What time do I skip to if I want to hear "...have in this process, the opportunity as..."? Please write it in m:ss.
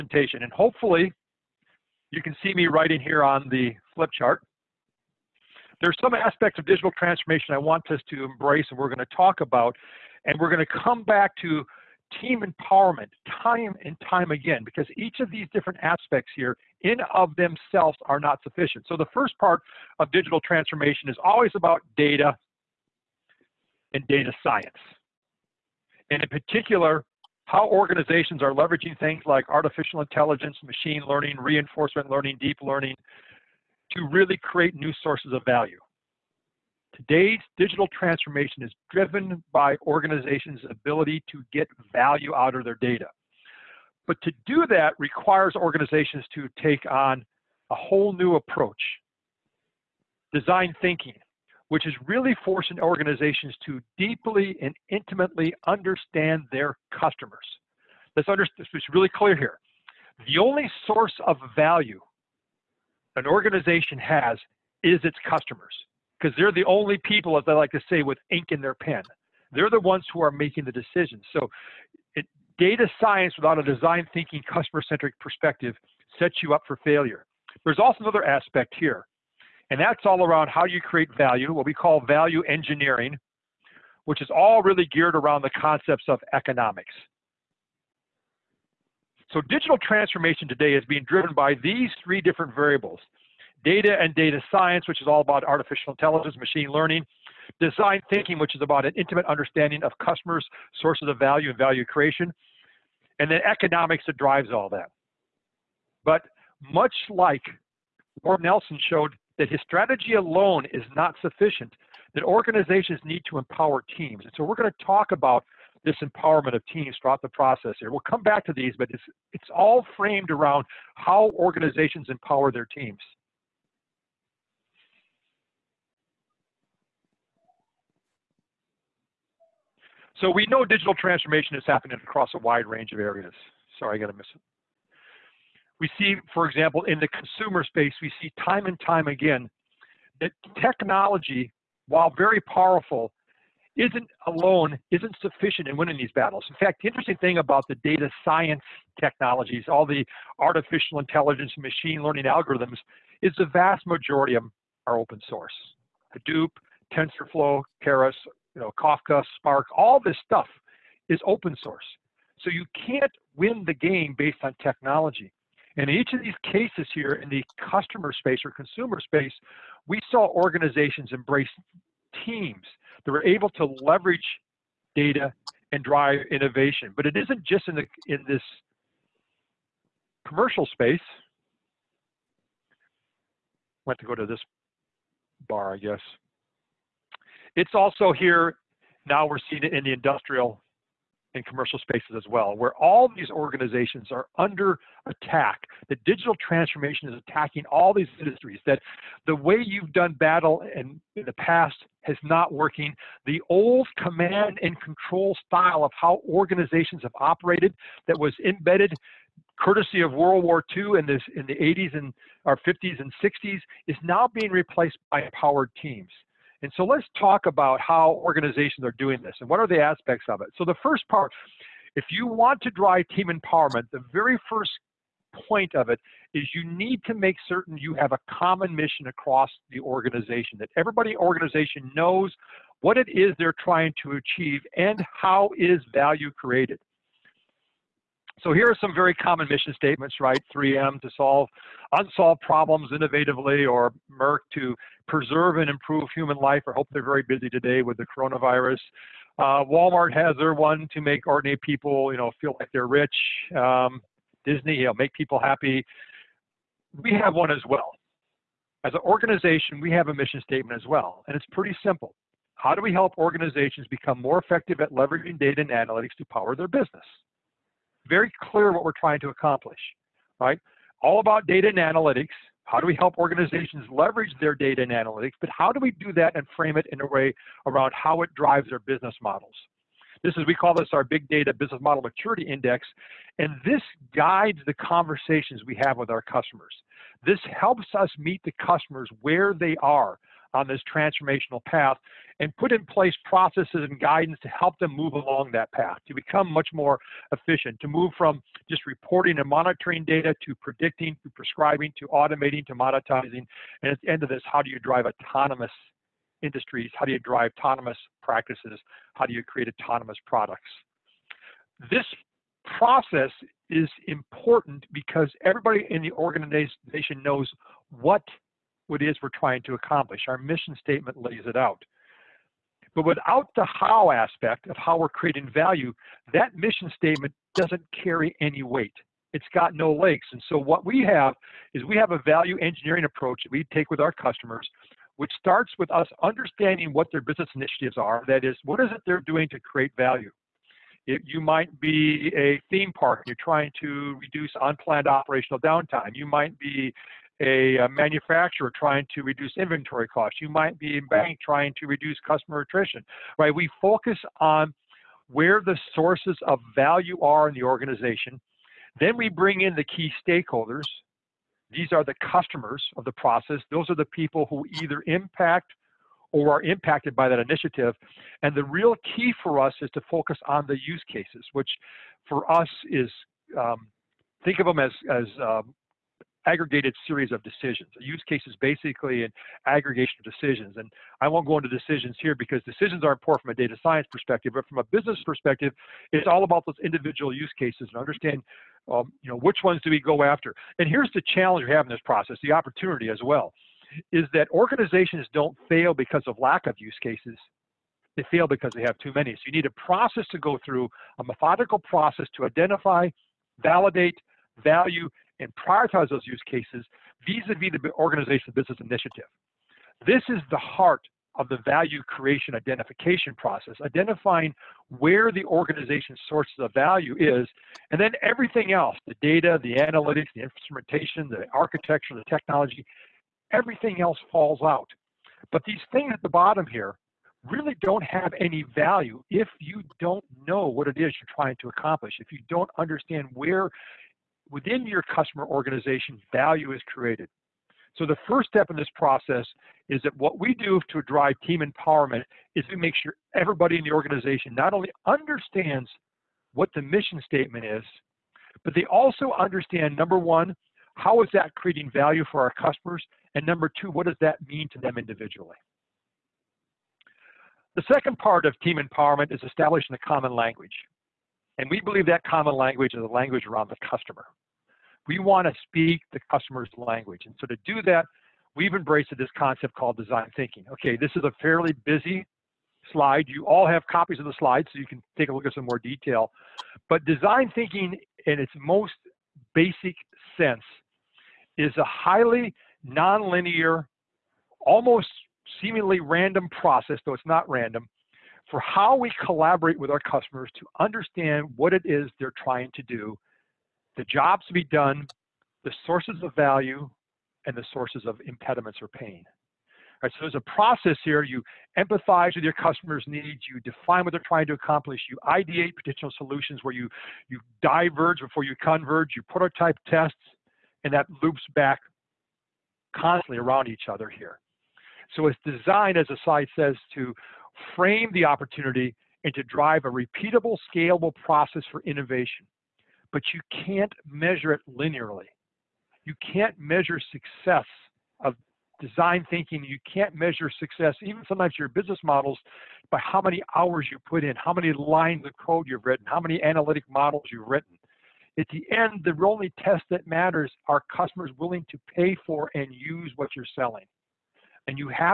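6:31.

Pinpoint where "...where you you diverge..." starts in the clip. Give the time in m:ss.
8:26.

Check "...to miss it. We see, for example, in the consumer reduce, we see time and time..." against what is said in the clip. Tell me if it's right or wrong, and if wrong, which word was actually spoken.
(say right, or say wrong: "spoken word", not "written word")
wrong: "space", not "reduce".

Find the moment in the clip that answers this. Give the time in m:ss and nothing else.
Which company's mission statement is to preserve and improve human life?
4:04.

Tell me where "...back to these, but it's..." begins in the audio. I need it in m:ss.
1:58.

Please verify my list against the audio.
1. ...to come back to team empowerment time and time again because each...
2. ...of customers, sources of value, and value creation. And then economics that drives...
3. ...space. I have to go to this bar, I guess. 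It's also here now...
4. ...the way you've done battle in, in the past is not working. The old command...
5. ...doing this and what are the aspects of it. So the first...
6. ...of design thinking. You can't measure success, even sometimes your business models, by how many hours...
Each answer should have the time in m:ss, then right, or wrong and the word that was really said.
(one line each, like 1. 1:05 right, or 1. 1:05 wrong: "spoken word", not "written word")
1. 0:10 right
2. 1:39 right
3. 3:00 right
4. 3:19 right
5. 3:38 right
6. 8:48 right.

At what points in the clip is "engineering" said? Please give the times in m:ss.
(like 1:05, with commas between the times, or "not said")
1:22, 5:32.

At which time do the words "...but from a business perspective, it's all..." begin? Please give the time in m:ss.
6:24.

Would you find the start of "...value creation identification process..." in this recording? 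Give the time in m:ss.
6:51.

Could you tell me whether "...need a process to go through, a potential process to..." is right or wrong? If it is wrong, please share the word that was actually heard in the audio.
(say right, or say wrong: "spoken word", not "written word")
wrong: "methodical", not "potential".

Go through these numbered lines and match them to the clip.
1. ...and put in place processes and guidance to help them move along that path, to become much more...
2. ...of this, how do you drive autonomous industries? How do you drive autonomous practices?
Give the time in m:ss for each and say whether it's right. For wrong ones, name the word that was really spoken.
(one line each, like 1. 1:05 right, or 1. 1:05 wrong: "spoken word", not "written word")
1. 4:52 right
2. 5:04 right.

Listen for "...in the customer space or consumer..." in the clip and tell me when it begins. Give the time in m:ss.
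2:47.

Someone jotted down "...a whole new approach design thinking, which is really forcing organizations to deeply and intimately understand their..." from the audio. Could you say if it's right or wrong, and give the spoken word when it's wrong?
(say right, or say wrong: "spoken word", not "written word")
right.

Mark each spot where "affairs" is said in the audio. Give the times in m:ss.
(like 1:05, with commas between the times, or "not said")
not said.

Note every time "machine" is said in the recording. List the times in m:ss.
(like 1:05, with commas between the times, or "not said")
0:30, 1:36, 2:31.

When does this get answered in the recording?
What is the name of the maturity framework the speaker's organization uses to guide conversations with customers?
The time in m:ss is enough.
4:41.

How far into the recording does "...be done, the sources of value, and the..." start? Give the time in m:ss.
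8:14.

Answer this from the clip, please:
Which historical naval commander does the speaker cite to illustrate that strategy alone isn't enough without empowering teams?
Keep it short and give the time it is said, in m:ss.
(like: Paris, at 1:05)
Lord Nelson, at 1:48.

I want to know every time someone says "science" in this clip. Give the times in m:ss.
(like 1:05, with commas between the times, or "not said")
0:24, 1:12, 1:34, 2:28, 6:23.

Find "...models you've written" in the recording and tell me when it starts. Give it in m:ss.
8:56.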